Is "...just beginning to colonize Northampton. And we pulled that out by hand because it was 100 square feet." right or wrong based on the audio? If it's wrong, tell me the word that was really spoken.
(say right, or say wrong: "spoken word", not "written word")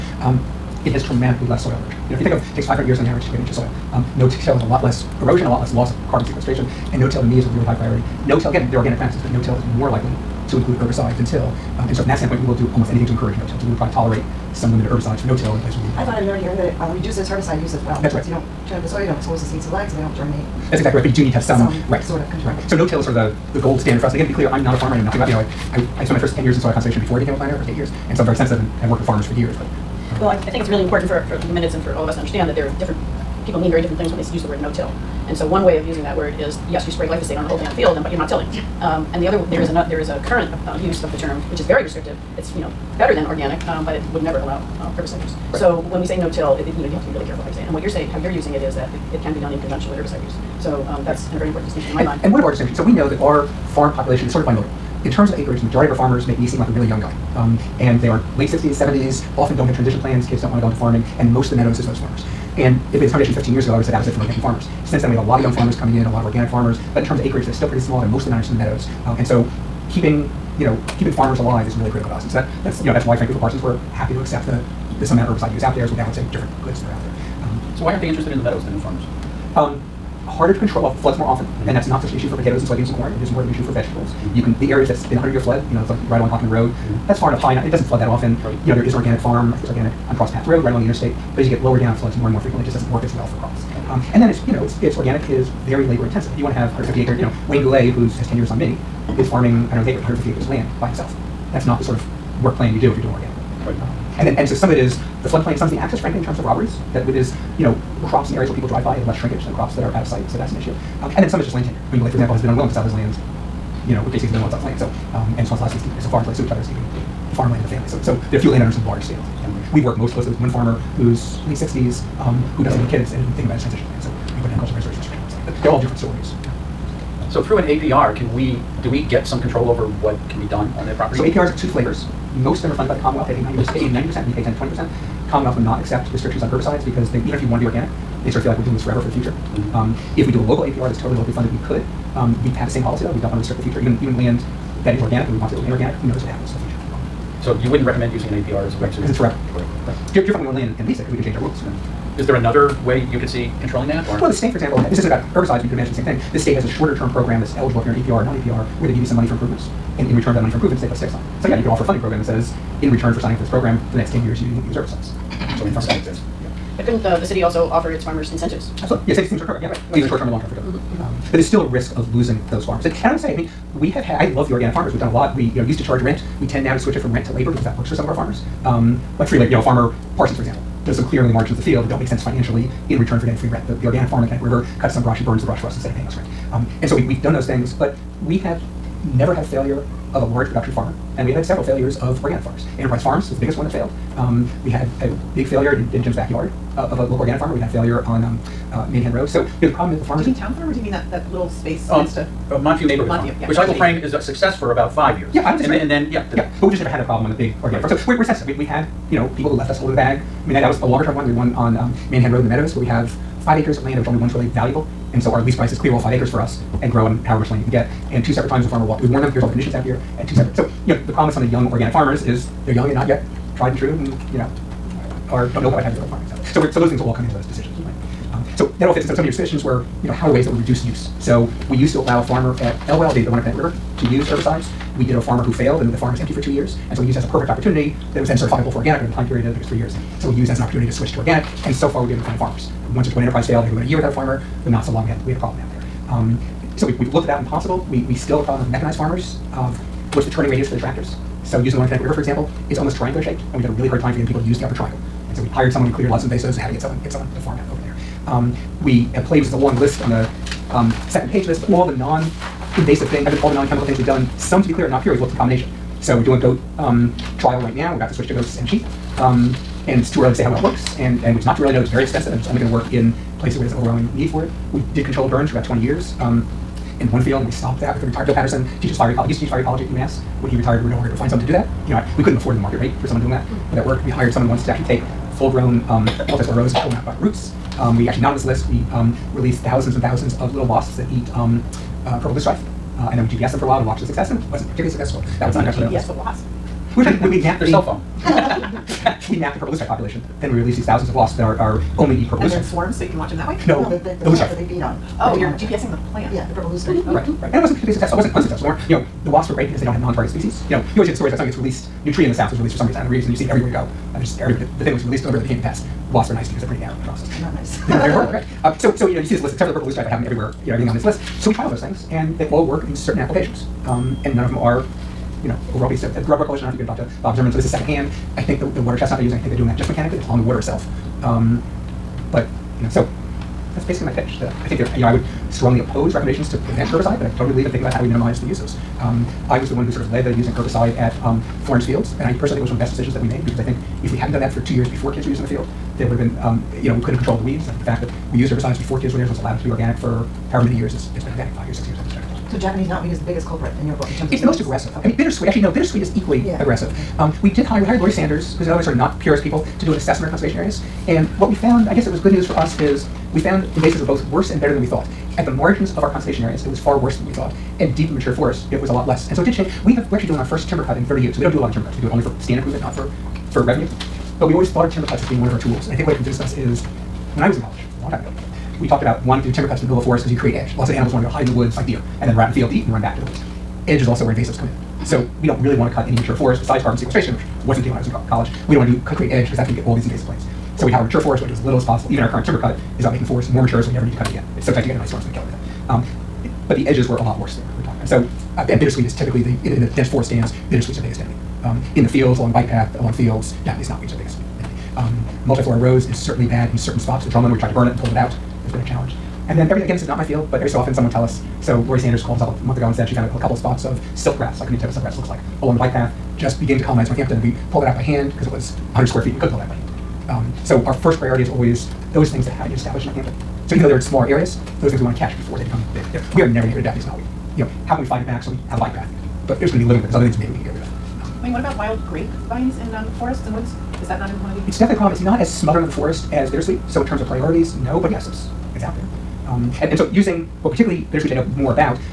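right.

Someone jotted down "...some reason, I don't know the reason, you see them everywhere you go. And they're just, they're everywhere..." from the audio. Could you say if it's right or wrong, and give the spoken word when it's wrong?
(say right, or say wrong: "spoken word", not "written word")
right.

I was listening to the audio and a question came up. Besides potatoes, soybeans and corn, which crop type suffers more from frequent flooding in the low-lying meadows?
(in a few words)
vegetables.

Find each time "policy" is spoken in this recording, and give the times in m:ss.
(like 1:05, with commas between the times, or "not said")
2:22.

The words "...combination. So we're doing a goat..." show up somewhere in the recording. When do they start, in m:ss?
4:25.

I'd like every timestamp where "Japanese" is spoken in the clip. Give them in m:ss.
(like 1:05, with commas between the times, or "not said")
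5:52, 6:43, 7:06.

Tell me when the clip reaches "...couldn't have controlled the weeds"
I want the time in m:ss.
5:47.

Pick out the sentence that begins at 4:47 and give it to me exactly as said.
Um, we actually, not on this list, we um, release thousands and thousands of little wasps that eat um, uh, purple loosestrife.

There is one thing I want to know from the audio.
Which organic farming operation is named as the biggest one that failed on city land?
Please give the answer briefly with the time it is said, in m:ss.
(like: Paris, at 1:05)
Enterprise Farms, at 3:12.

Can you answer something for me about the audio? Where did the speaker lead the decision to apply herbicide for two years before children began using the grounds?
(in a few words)
Florence Fields.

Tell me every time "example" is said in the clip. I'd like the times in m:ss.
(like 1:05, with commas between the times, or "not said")
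1:52, 2:34, 3:00, 4:12.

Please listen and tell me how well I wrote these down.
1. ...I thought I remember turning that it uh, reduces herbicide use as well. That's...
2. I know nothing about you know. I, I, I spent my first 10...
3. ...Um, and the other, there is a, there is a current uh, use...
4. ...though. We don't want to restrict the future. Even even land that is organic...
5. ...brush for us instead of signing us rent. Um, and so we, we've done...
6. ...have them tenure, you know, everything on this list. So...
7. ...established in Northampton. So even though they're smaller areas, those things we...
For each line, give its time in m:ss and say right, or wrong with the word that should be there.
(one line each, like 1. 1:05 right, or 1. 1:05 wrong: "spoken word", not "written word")
1. 0:15 wrong: "hearing", not "turning"
2. 0:24 right
3. 0:38 right
4. 2:23 right
5. 3:05 wrong: "paying", not "signing"
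6. 5:20 wrong: "everywhere", not "tenure"
7. 7:02 right.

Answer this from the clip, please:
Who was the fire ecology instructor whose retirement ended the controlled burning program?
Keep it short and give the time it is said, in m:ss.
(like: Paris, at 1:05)
Bill Patterson, at 4:38.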